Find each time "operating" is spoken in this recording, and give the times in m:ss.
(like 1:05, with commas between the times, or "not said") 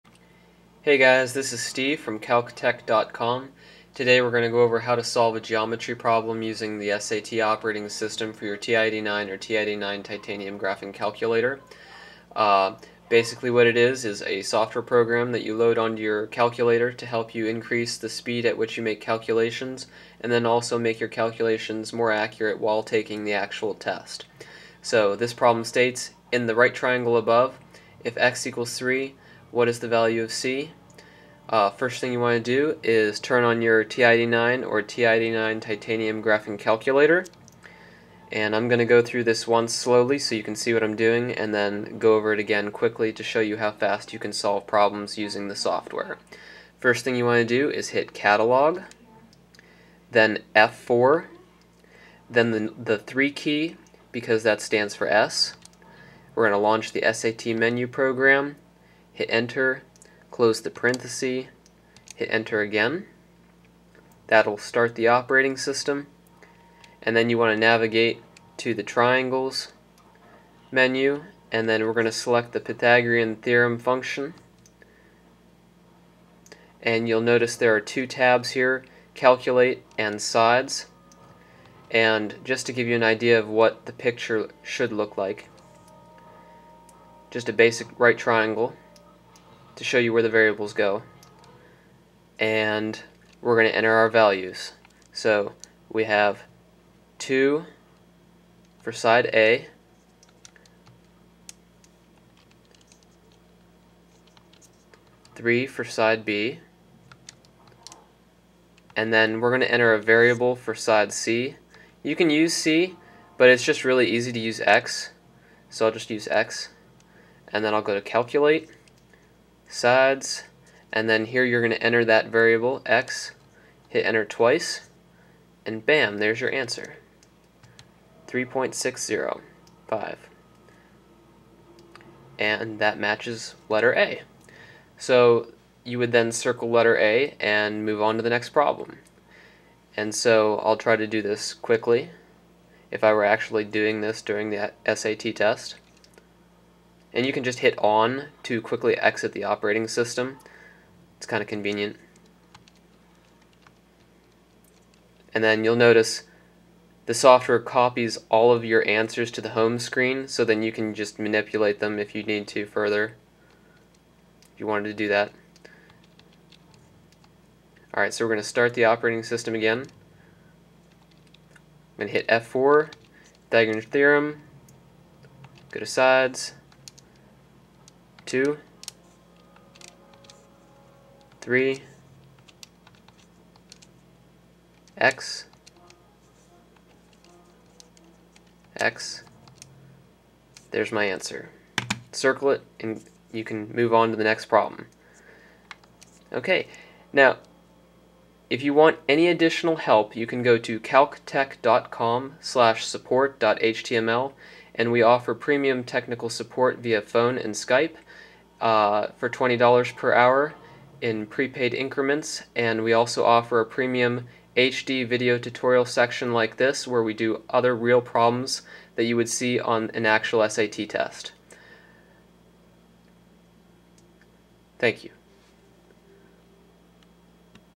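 0:07, 1:05, 2:29, 2:48.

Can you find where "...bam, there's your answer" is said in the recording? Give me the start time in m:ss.
2:05.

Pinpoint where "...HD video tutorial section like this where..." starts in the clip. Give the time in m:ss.
3:34.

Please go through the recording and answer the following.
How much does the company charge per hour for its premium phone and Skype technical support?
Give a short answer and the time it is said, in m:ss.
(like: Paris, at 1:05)
$20, at 3:29.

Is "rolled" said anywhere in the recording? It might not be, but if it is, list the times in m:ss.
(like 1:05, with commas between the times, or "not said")
not said.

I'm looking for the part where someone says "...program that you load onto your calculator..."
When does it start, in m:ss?
0:14.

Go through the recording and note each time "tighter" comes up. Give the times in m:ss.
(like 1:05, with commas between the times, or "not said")
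not said.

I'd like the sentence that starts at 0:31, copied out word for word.
Uh, first thing you want to do is turn on your TI-89 or TI-89 titanium graphing calculator.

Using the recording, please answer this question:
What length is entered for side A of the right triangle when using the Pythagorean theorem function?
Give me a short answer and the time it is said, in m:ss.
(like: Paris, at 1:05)
2, at 1:37.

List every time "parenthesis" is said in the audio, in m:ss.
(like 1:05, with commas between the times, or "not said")
1:00.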